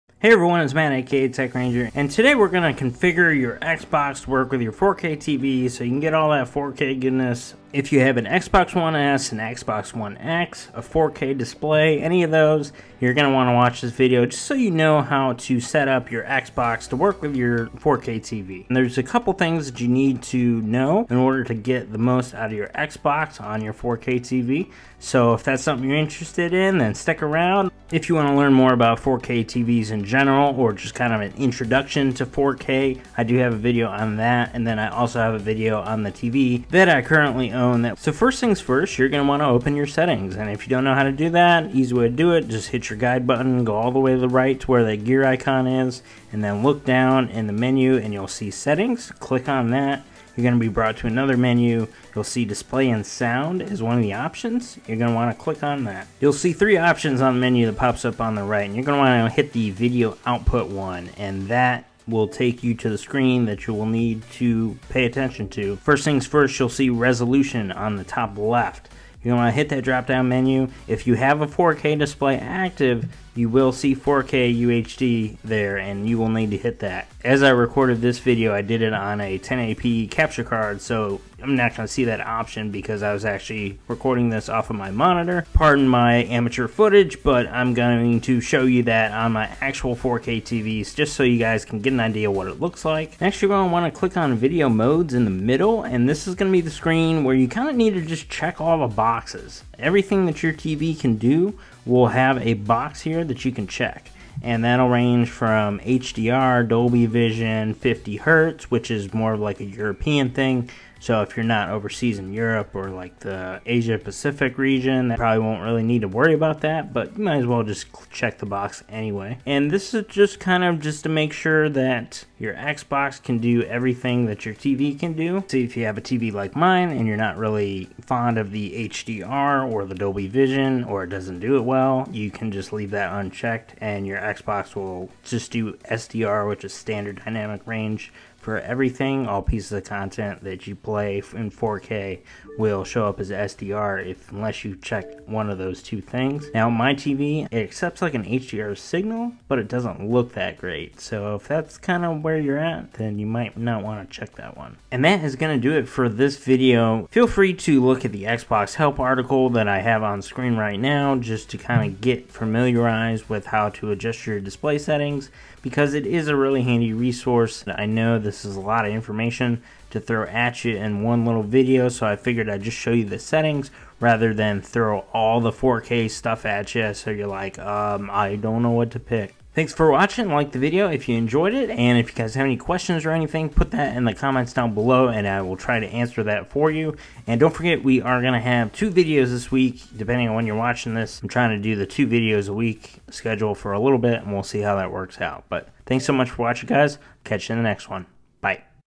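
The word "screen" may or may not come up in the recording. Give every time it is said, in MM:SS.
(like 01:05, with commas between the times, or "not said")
01:02, 01:36, 02:40.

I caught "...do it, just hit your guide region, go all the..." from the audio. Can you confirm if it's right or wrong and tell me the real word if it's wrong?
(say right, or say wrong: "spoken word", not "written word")
wrong: "button", not "region".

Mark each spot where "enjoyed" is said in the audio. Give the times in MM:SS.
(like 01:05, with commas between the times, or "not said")
03:01.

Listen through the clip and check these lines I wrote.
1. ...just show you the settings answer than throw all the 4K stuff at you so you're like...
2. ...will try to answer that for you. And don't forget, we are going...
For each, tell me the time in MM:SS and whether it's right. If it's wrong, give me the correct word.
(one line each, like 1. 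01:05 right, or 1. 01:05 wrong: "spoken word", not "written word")
1. 02:52 wrong: "rather", not "answer"
2. 03:05 right.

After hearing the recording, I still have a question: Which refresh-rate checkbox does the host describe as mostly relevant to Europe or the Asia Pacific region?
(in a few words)
50 Hertz.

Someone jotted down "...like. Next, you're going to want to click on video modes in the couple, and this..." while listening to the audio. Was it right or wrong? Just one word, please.
wrong.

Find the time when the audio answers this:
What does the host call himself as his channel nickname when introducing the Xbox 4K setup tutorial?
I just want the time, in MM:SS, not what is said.
00:01.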